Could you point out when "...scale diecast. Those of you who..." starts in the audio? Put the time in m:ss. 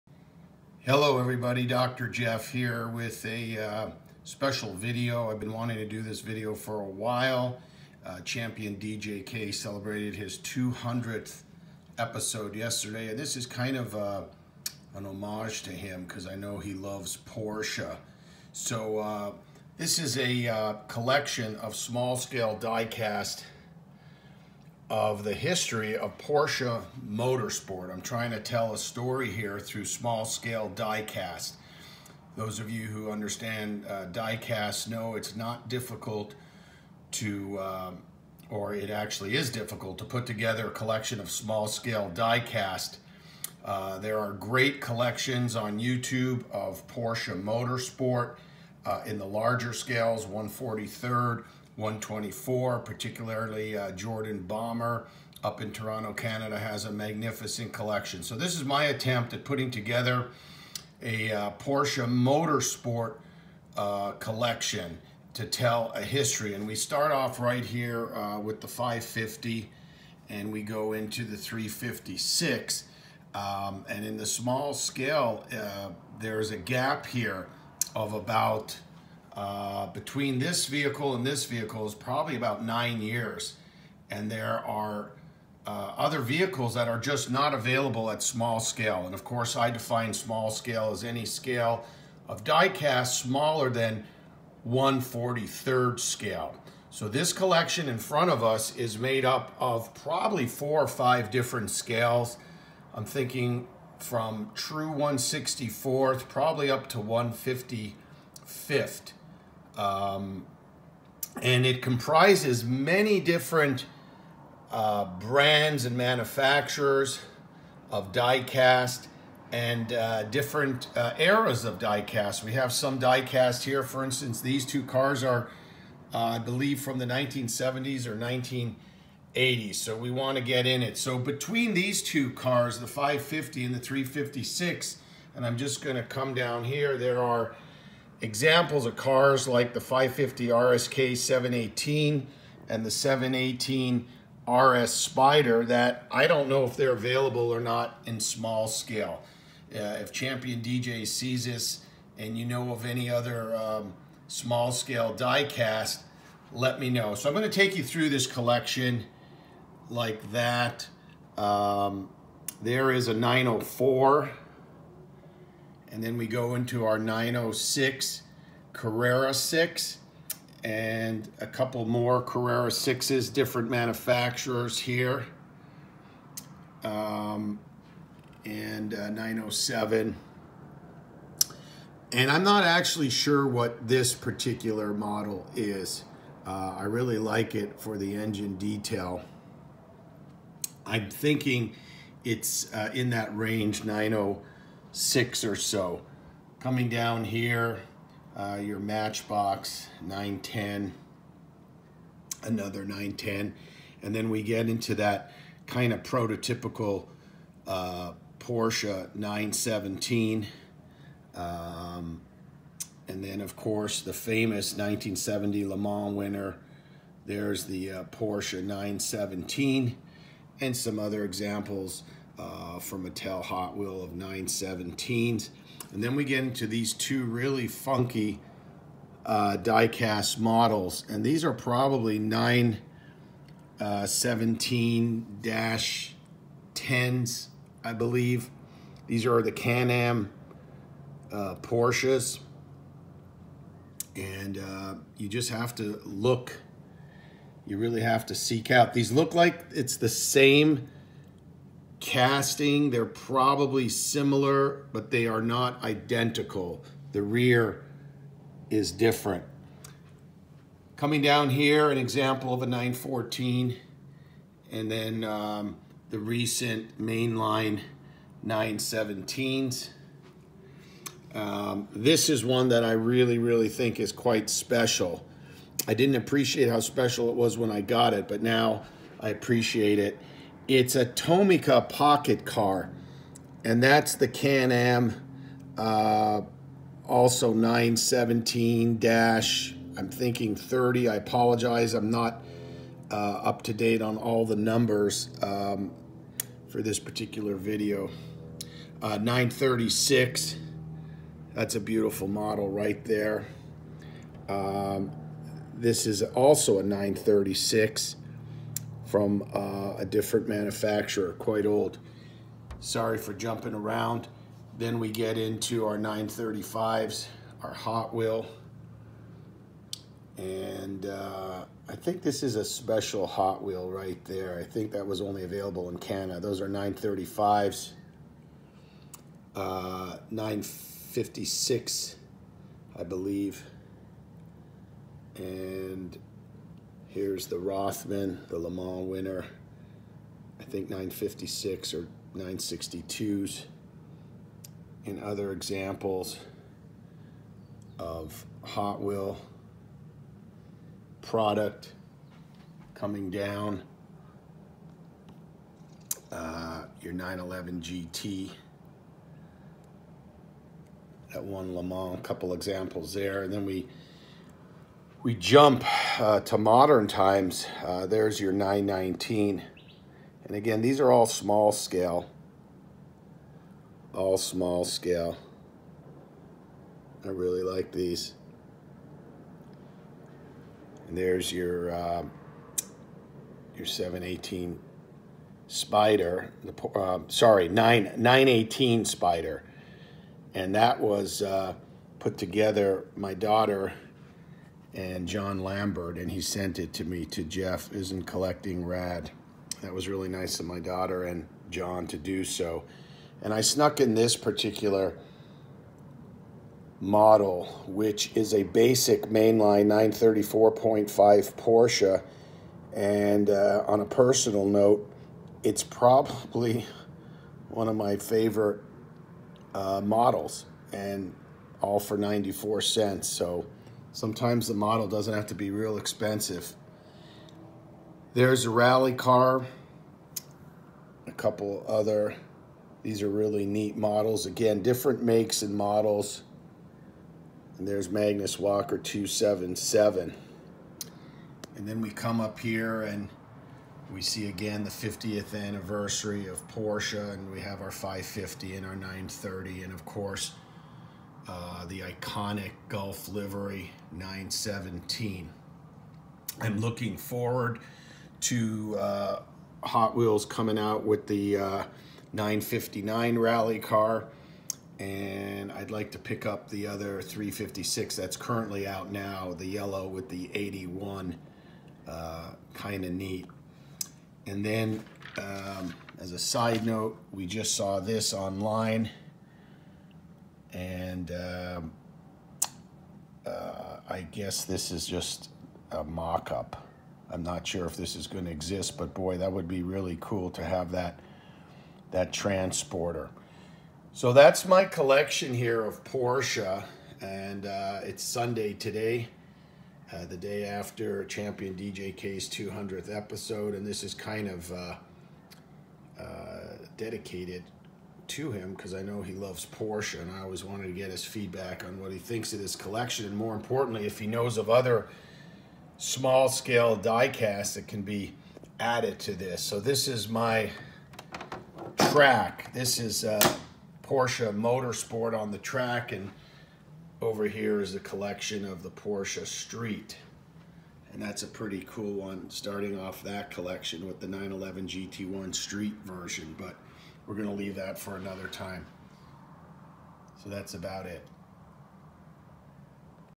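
0:30.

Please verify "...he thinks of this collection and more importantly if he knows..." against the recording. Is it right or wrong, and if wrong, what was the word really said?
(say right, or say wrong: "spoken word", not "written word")
right.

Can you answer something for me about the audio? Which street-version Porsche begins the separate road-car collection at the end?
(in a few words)
911 GT1.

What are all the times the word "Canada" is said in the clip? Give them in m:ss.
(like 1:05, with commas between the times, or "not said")
0:56, 5:25.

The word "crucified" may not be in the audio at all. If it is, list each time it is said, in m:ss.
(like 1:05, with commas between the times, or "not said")
not said.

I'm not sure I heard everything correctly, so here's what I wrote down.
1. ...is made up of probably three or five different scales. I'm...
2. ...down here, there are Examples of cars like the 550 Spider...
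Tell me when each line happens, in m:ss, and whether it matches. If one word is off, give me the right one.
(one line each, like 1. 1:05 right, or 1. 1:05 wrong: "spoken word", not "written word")
1. 1:38 wrong: "four", not "three"
2. 2:16 wrong: "RSK", not "Spider".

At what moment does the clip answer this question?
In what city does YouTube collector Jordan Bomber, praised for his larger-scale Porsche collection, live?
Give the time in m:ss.
0:55.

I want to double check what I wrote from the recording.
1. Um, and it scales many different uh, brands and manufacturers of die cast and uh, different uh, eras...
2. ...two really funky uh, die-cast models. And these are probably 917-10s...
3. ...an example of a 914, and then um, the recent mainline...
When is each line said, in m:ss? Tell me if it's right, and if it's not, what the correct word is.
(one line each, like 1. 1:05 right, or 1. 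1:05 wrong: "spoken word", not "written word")
1. 1:49 wrong: "comprises", not "scales"
2. 3:46 right
3. 4:21 right.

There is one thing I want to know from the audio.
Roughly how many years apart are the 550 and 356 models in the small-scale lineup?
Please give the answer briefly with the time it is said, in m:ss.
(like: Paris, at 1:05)
9, at 1:22.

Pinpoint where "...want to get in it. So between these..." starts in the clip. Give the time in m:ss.
2:10.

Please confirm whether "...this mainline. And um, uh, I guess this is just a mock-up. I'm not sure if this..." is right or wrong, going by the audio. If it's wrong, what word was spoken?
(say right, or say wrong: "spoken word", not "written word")
wrong: "online", not "mainline".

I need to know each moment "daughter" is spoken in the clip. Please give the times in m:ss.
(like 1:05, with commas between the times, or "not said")
6:33, 6:40.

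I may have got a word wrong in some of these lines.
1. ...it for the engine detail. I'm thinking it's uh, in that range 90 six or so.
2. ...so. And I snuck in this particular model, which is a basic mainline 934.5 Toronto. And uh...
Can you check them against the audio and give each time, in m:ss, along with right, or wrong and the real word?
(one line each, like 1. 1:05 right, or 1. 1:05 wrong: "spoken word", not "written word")
1. 3:07 right
2. 6:42 wrong: "Porsche", not "Toronto".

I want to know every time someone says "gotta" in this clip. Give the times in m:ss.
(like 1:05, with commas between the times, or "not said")
not said.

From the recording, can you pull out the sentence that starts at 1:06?
And we start off right here uh, with the 550 and we go into the 356.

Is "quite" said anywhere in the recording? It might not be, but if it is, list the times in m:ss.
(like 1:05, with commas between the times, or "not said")
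4:34, 5:11.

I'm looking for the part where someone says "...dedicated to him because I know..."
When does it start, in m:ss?
8:26.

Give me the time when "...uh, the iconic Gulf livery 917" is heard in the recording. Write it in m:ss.
7:31.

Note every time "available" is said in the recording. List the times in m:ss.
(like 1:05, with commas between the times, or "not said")
1:27, 2:26, 5:25.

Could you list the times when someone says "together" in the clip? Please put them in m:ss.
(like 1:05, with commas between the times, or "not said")
0:40, 0:59, 6:32.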